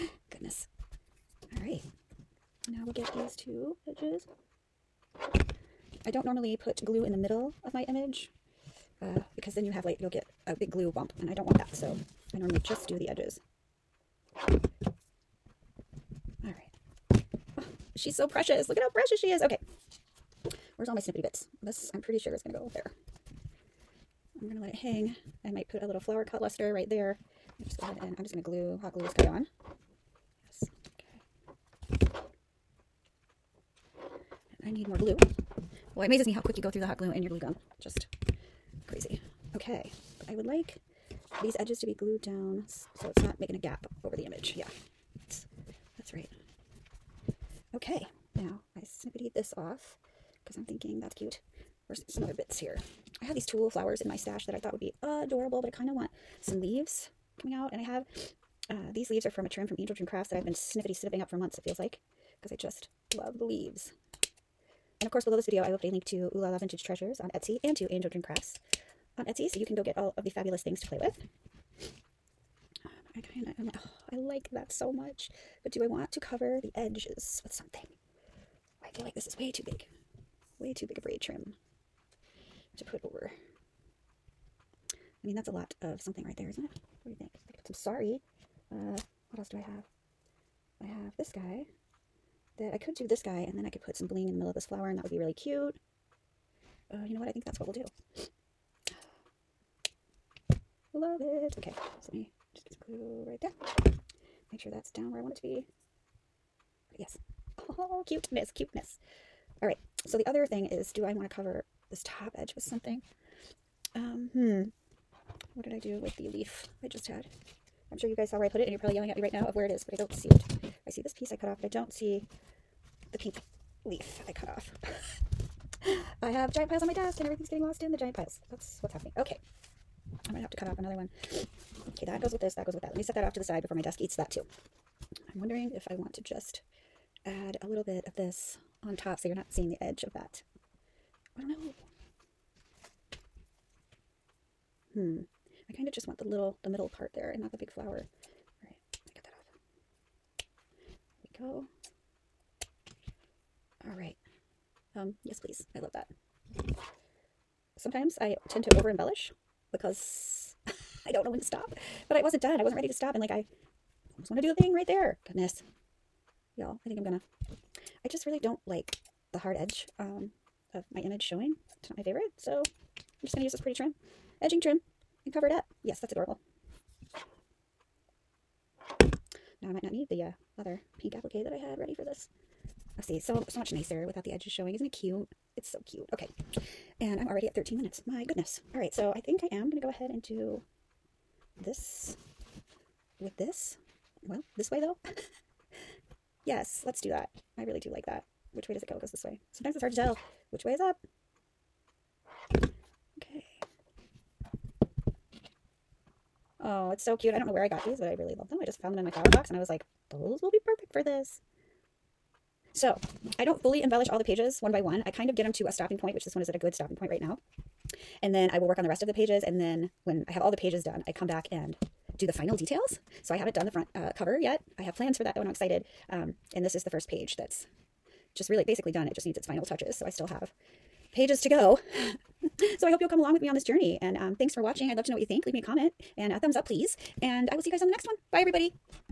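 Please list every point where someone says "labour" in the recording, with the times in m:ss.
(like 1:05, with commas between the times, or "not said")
not said.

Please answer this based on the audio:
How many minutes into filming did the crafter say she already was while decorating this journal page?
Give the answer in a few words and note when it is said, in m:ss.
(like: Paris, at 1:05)
13, at 3:07.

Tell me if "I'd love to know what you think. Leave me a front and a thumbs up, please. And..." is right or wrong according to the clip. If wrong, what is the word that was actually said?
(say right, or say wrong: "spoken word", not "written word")
wrong: "comment", not "front".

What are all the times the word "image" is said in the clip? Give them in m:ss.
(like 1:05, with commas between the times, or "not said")
0:07, 0:44, 2:50.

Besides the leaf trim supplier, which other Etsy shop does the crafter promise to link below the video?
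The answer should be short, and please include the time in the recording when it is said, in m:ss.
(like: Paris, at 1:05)
Ooh La Vintage Treasures, at 1:06.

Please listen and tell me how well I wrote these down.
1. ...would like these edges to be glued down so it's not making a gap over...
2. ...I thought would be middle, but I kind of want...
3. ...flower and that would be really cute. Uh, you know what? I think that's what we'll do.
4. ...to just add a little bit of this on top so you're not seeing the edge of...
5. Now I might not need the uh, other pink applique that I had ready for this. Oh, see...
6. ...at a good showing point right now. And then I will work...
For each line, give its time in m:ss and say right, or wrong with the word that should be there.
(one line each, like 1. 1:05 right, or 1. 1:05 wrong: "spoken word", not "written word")
1. 0:40 right
2. 0:54 wrong: "adorable", not "middle"
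3. 1:34 right
4. 2:16 right
5. 2:59 right
6. 3:36 wrong: "stopping", not "showing".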